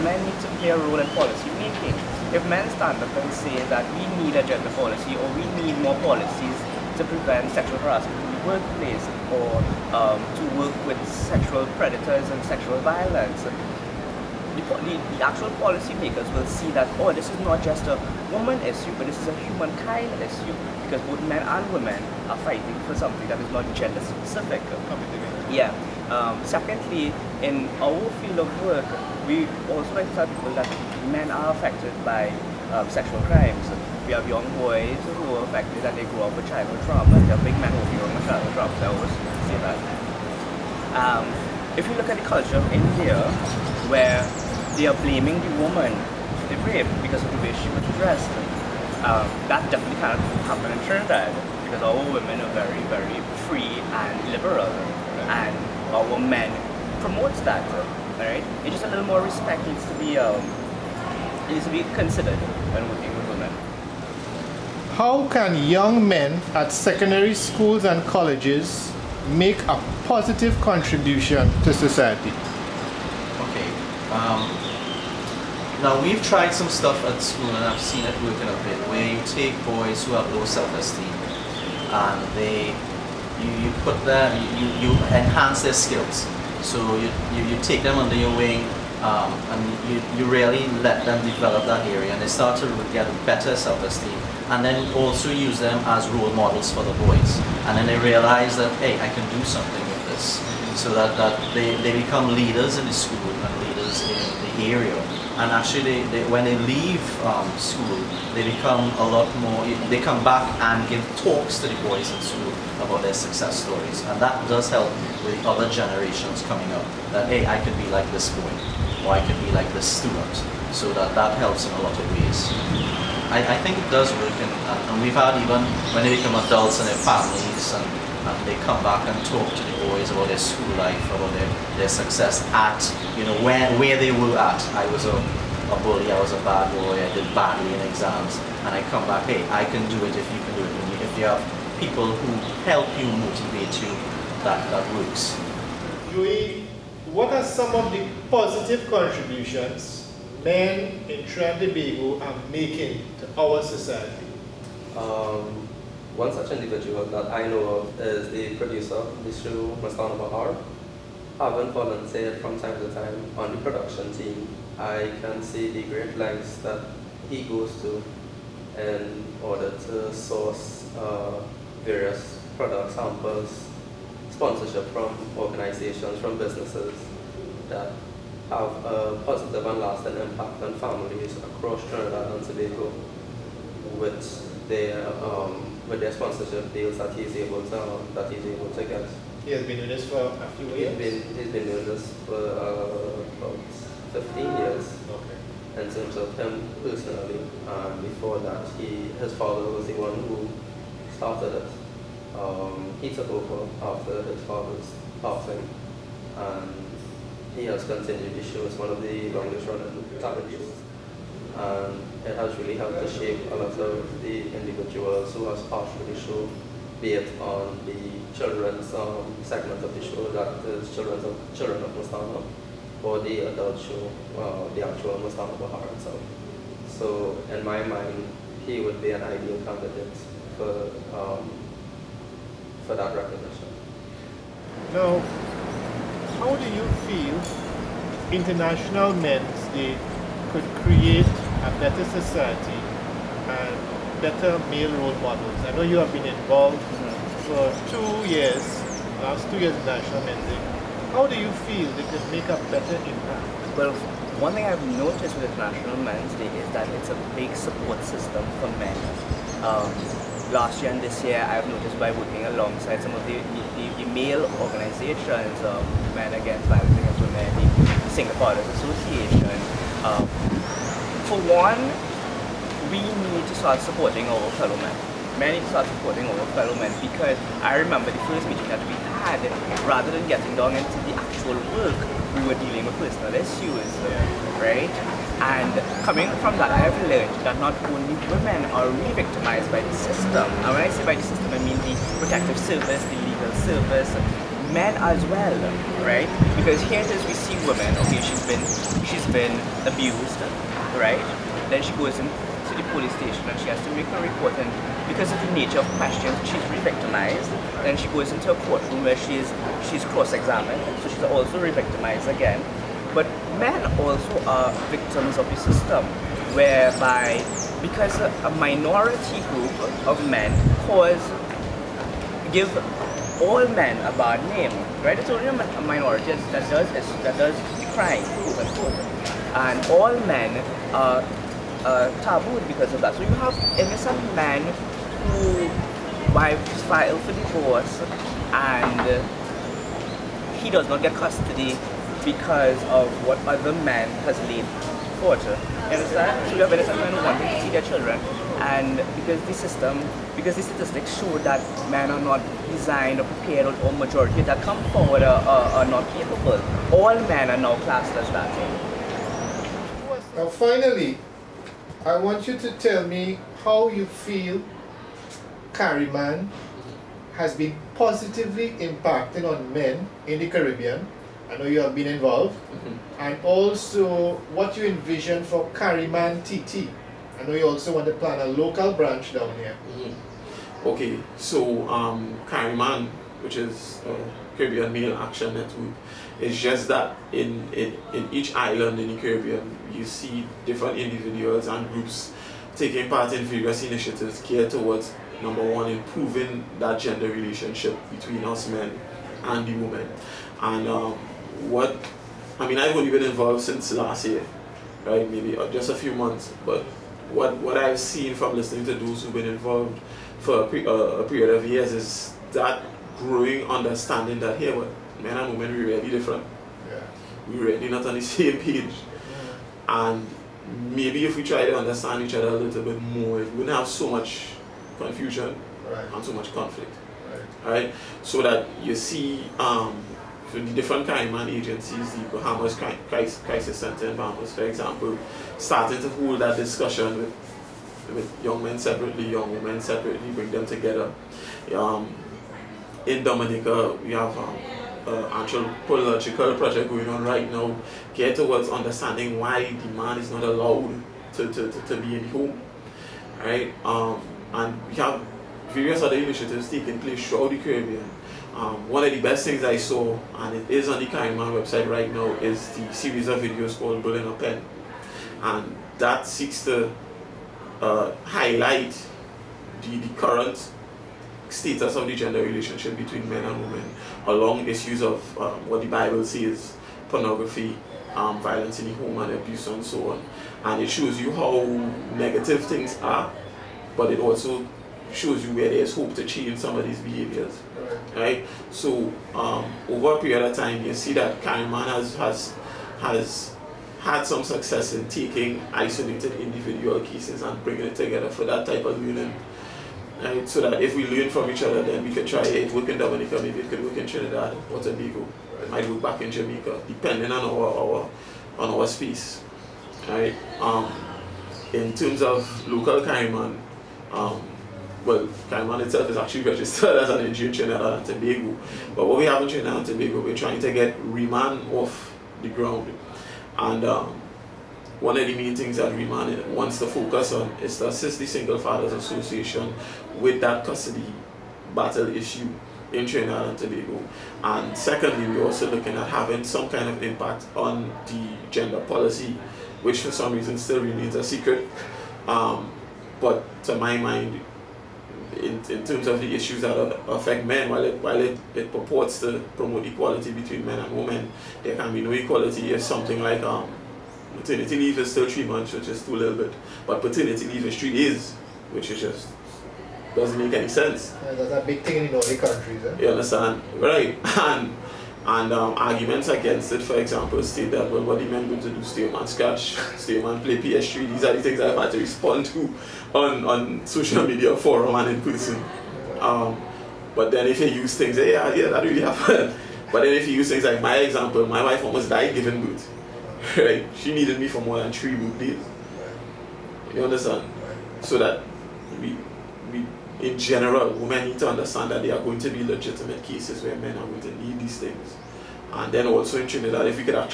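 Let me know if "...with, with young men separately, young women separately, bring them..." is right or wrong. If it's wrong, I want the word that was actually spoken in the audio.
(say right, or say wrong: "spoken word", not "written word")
right.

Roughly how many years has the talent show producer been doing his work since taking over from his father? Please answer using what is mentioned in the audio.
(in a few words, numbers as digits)
15 years.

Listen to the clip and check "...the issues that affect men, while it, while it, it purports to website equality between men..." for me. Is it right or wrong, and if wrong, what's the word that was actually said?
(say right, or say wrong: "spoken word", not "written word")
wrong: "promote", not "website".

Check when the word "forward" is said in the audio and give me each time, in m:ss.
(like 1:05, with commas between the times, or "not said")
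5:54.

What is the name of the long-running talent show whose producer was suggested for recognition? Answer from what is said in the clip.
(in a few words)
Mastana Bahar.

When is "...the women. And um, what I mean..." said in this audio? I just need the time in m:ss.
6:39.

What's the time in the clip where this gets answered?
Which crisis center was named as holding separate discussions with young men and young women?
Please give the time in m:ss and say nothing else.
7:12.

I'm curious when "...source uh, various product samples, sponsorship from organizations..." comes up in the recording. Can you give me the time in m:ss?
2:50.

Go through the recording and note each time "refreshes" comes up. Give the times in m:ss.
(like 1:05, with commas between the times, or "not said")
not said.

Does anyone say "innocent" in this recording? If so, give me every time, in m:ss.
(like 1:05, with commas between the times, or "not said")
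5:33, 5:46.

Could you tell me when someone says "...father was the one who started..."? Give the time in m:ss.
3:19.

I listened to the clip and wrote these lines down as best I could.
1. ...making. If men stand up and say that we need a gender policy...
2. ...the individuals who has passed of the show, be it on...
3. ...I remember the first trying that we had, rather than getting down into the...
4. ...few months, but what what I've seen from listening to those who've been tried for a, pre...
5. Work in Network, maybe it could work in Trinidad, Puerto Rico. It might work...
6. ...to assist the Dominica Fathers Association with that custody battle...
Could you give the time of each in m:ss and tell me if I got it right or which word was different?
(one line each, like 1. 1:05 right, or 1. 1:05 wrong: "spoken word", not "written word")
1. 0:01 right
2. 3:34 right
3. 4:37 wrong: "meeting", not "trying"
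4. 6:45 wrong: "involved", not "tried"
5. 8:22 wrong: "Dominica", not "Network"
6. 8:47 wrong: "Single", not "Dominica".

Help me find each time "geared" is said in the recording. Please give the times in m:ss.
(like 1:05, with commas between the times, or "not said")
6:34, 7:28.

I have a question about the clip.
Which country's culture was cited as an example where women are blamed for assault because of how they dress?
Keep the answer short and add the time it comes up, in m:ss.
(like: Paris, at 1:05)
India, at 0:42.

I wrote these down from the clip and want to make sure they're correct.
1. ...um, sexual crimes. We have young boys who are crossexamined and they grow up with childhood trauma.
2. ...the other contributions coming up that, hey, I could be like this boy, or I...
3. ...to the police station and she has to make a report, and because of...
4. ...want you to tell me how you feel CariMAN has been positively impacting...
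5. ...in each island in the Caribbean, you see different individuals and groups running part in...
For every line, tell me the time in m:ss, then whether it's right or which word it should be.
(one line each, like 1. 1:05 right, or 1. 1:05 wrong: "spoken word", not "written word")
1. 0:32 wrong: "affected", not "crossexamined"
2. 1:55 wrong: "generations", not "contributions"
3. 5:02 right
4. 6:02 right
5. 6:28 wrong: "taking", not "running".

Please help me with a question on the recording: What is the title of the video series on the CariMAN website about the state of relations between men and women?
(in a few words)
Building a Pen.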